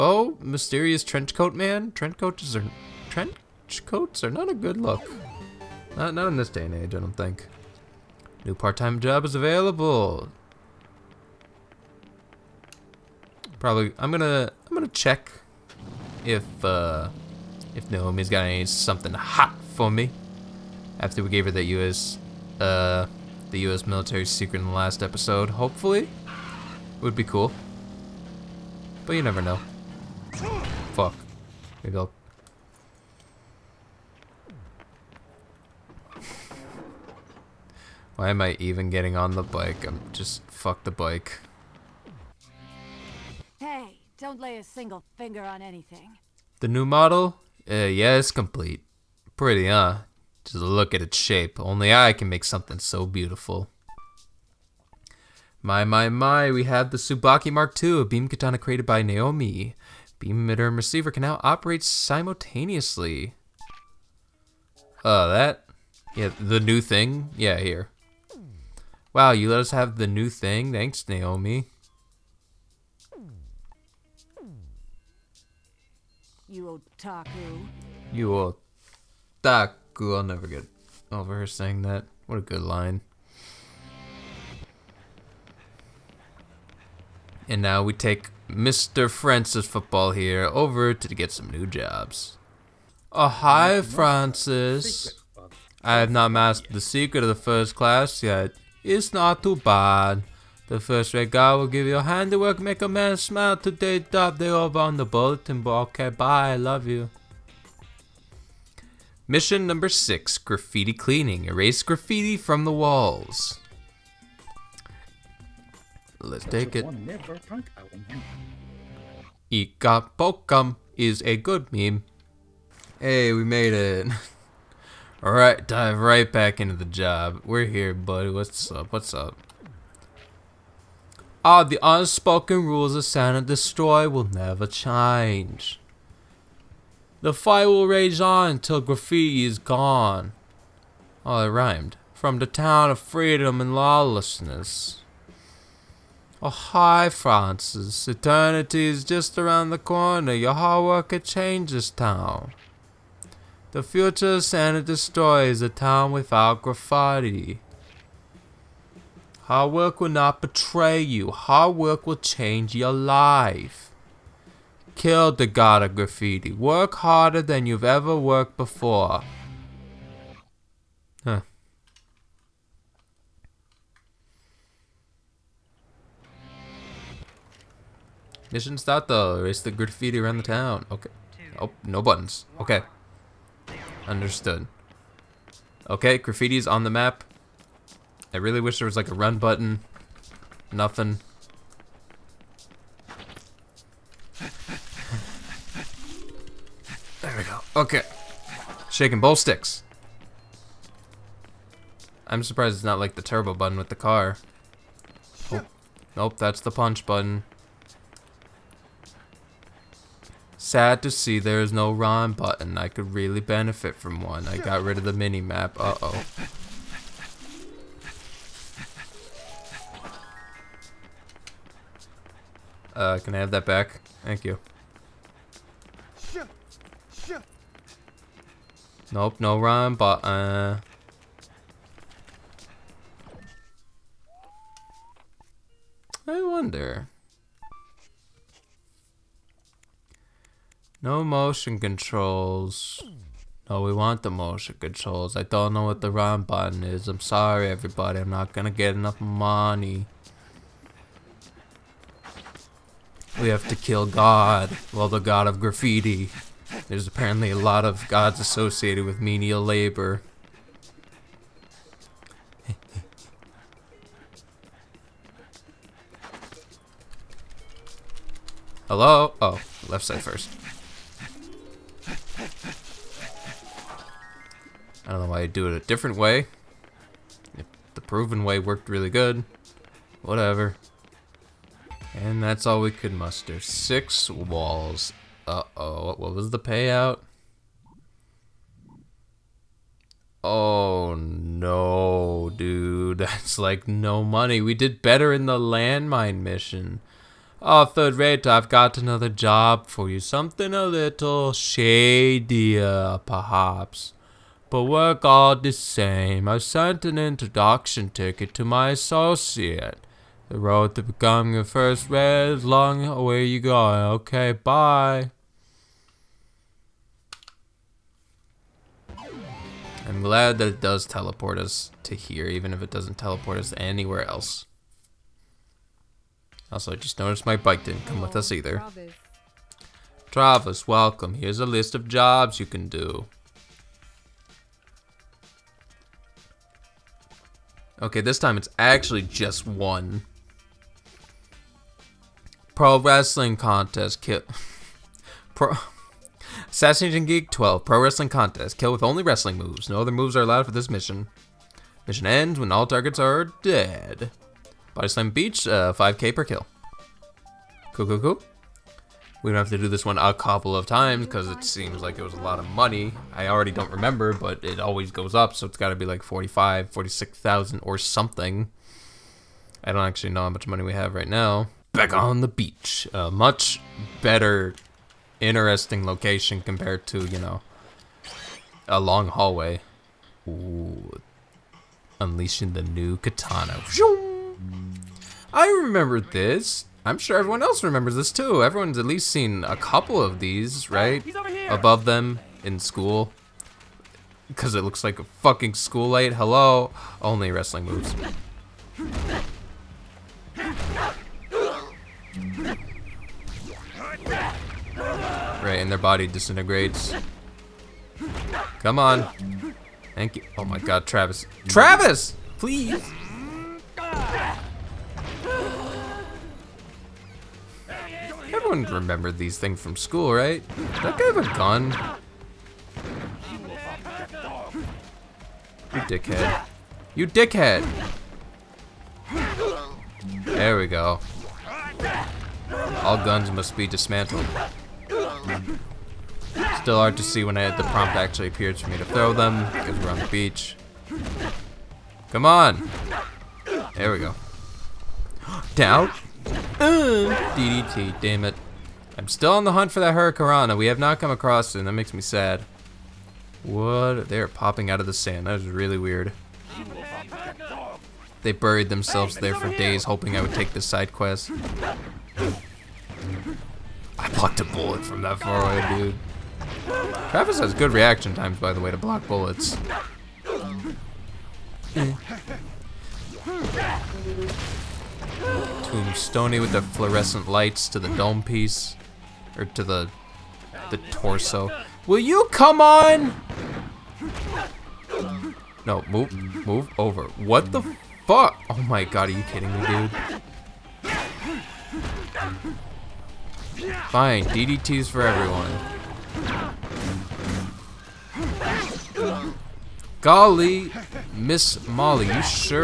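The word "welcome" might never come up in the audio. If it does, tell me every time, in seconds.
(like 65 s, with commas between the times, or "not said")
330 s.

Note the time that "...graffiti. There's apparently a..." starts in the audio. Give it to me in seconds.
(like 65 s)
255 s.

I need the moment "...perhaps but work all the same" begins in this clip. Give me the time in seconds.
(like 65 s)
303 s.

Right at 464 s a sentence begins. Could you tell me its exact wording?
I blocked a bullet from that far away, dude.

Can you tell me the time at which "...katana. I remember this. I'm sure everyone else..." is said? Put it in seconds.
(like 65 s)
383 s.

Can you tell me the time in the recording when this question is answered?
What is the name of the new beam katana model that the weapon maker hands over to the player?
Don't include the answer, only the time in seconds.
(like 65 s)
56 s.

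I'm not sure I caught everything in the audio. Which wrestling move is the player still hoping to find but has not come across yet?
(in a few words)
Hurricanrana.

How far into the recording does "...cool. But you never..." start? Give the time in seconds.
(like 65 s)
27 s.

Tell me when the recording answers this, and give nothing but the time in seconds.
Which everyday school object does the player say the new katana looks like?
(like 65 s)
395 s.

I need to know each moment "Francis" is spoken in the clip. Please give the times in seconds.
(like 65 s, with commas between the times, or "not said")
89 s, 93 s, 147 s.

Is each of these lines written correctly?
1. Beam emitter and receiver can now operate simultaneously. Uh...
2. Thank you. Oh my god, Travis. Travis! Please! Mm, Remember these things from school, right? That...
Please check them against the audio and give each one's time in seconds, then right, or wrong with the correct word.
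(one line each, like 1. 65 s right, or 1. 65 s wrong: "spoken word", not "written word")
1. 60 s right
2. 410 s right.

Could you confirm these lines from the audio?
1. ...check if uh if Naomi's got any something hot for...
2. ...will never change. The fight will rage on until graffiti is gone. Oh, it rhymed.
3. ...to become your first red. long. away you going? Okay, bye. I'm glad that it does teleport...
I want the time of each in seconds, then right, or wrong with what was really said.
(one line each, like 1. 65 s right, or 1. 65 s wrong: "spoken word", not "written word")
1. 14 s right
2. 134 s right
3. 310 s right.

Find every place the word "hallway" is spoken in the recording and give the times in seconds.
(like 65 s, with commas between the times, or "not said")
379 s.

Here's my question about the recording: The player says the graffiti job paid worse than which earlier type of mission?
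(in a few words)
landmine mission.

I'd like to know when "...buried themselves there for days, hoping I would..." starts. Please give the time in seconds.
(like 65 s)
458 s.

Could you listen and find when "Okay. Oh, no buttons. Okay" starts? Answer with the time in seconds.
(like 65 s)
180 s.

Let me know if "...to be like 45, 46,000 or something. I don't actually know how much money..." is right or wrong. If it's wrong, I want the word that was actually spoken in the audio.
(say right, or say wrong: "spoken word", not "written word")
right.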